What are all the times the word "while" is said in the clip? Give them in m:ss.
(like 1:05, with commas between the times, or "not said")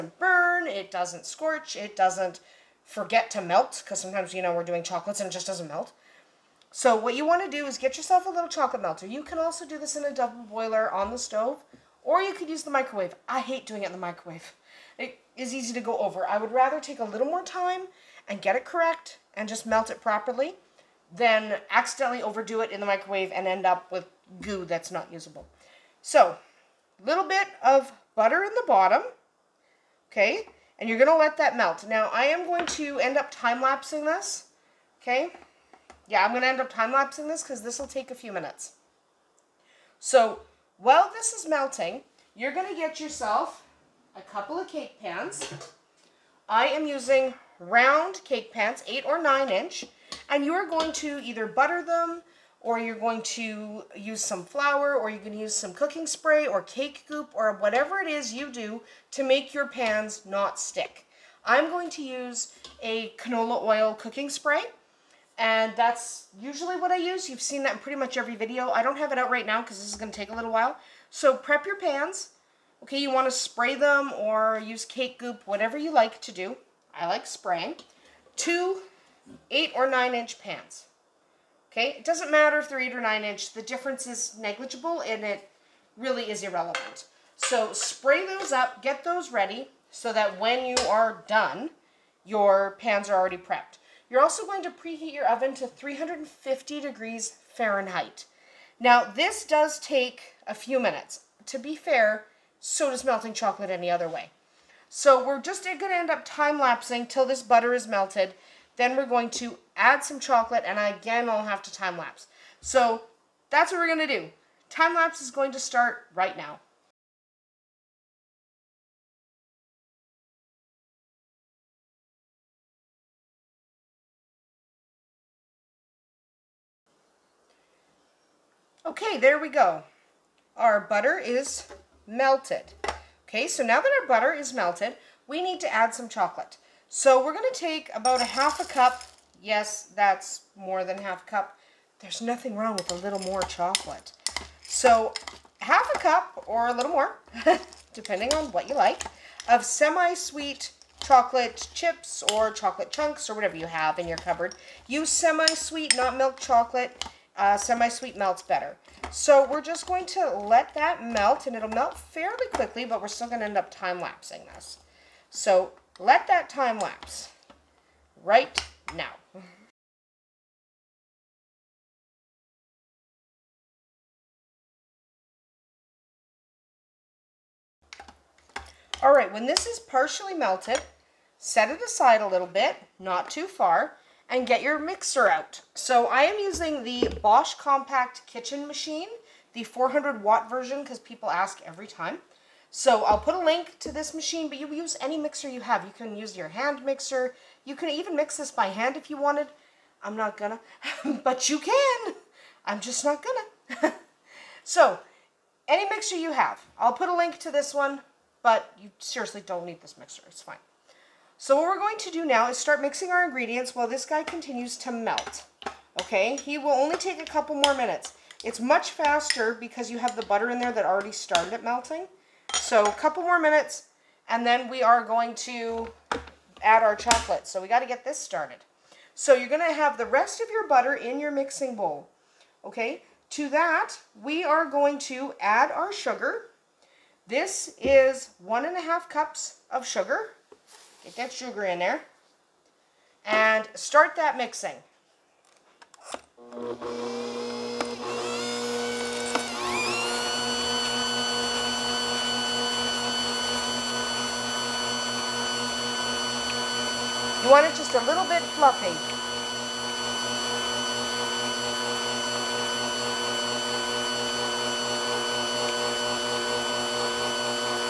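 0:40, 1:10, 3:33.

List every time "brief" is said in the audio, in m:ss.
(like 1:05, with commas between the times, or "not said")
not said.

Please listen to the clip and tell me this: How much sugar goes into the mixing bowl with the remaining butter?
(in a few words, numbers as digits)
1 1/2 cups.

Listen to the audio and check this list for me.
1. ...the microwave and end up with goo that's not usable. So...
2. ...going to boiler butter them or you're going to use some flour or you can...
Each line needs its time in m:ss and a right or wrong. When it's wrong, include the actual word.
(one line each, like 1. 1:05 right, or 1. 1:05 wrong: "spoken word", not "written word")
1. 0:22 right
2. 0:50 wrong: "either", not "boiler".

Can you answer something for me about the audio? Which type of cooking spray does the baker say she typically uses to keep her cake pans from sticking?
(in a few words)
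canola oil cooking spray.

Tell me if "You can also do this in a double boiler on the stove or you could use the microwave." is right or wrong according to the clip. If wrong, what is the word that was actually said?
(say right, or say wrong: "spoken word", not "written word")
right.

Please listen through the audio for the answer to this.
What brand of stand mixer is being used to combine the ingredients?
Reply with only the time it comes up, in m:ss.
3:07.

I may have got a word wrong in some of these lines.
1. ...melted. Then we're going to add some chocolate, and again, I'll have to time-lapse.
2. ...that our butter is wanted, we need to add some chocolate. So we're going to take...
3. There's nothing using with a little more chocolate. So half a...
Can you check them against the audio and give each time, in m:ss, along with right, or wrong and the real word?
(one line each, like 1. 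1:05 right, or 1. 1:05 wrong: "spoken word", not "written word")
1. 1:47 right
2. 2:13 wrong: "melted", not "wanted"
3. 2:21 wrong: "wrong", not "using".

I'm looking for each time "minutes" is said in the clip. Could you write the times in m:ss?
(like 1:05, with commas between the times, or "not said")
0:38, 1:40, 3:37, 3:43.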